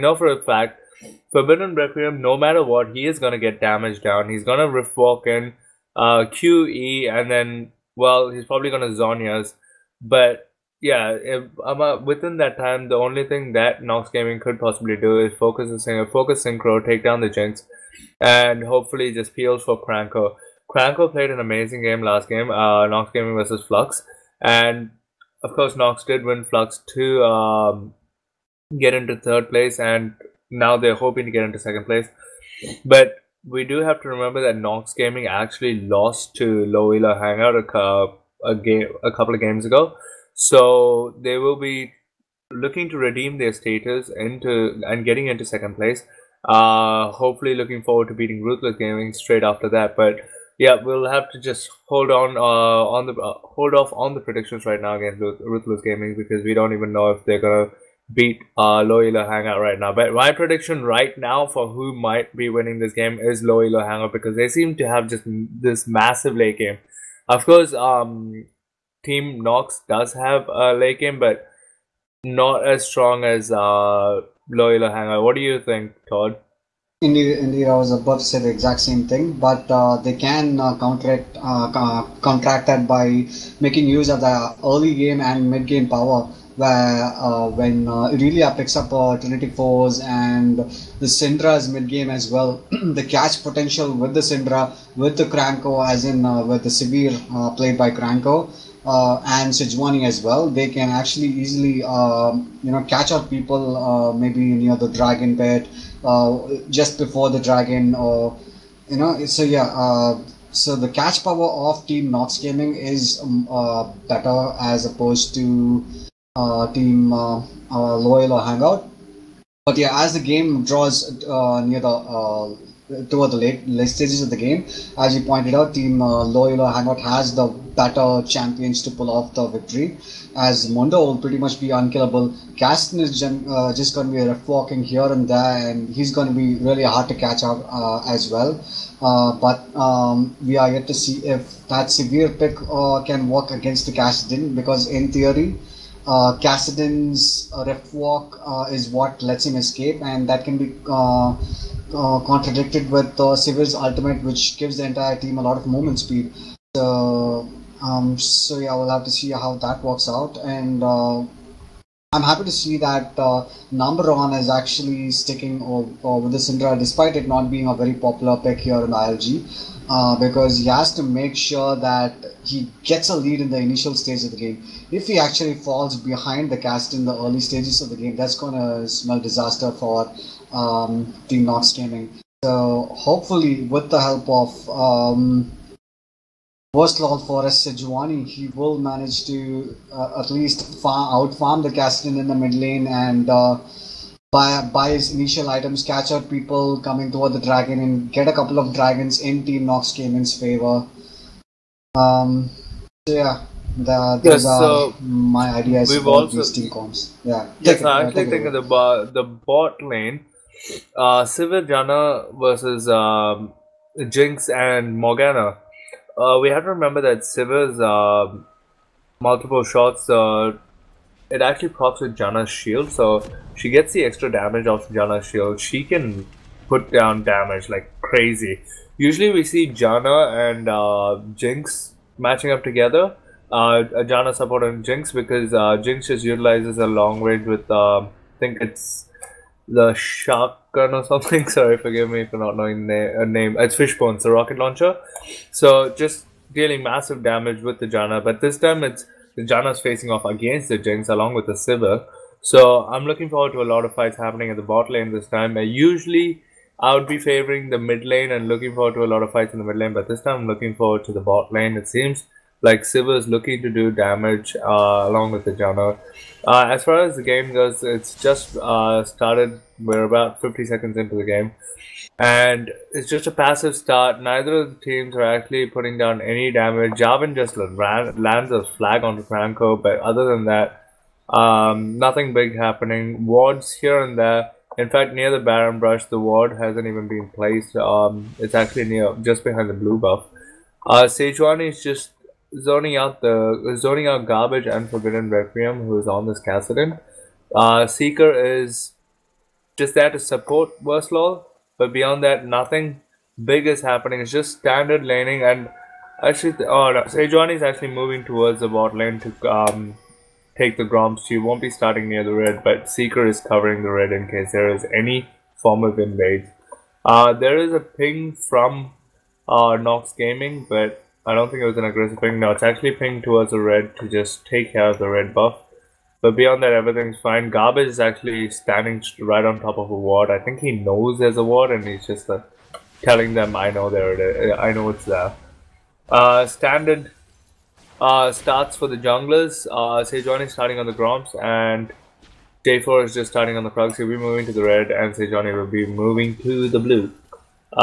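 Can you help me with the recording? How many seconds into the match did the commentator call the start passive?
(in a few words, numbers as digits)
50.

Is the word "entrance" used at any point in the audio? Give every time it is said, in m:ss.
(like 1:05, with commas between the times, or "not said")
not said.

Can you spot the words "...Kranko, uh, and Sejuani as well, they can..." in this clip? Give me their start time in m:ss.
1:37.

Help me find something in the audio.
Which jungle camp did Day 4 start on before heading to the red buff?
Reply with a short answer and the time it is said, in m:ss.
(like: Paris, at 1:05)
Krugs, at 5:43.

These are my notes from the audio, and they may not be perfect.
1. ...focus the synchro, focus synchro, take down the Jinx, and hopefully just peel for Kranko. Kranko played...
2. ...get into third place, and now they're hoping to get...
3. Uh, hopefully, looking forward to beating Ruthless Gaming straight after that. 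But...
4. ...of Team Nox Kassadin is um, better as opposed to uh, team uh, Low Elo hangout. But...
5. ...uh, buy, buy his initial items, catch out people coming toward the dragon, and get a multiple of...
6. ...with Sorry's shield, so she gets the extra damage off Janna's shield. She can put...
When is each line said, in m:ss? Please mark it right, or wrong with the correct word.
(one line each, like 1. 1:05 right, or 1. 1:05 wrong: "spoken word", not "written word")
1. 0:15 right
2. 0:28 right
3. 0:46 right
4. 1:51 wrong: "Gaming", not "Kassadin"
5. 3:13 wrong: "couple", not "multiple"
6. 3:42 wrong: "Janna", not "Sorry".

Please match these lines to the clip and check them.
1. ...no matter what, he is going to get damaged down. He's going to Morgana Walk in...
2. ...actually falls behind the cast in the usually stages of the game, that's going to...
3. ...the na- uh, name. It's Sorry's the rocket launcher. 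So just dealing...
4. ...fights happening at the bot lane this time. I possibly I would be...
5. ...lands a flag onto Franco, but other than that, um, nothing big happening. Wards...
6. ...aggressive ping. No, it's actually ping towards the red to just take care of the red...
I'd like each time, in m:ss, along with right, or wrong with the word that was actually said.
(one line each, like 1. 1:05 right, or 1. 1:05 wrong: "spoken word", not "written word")
1. 0:02 wrong: "Rift", not "Morgana"
2. 2:55 wrong: "early", not "usually"
3. 4:02 wrong: "Fishbone", not "Sorry"
4. 4:13 wrong: "usually", not "possibly"
5. 4:38 right
6. 5:21 right.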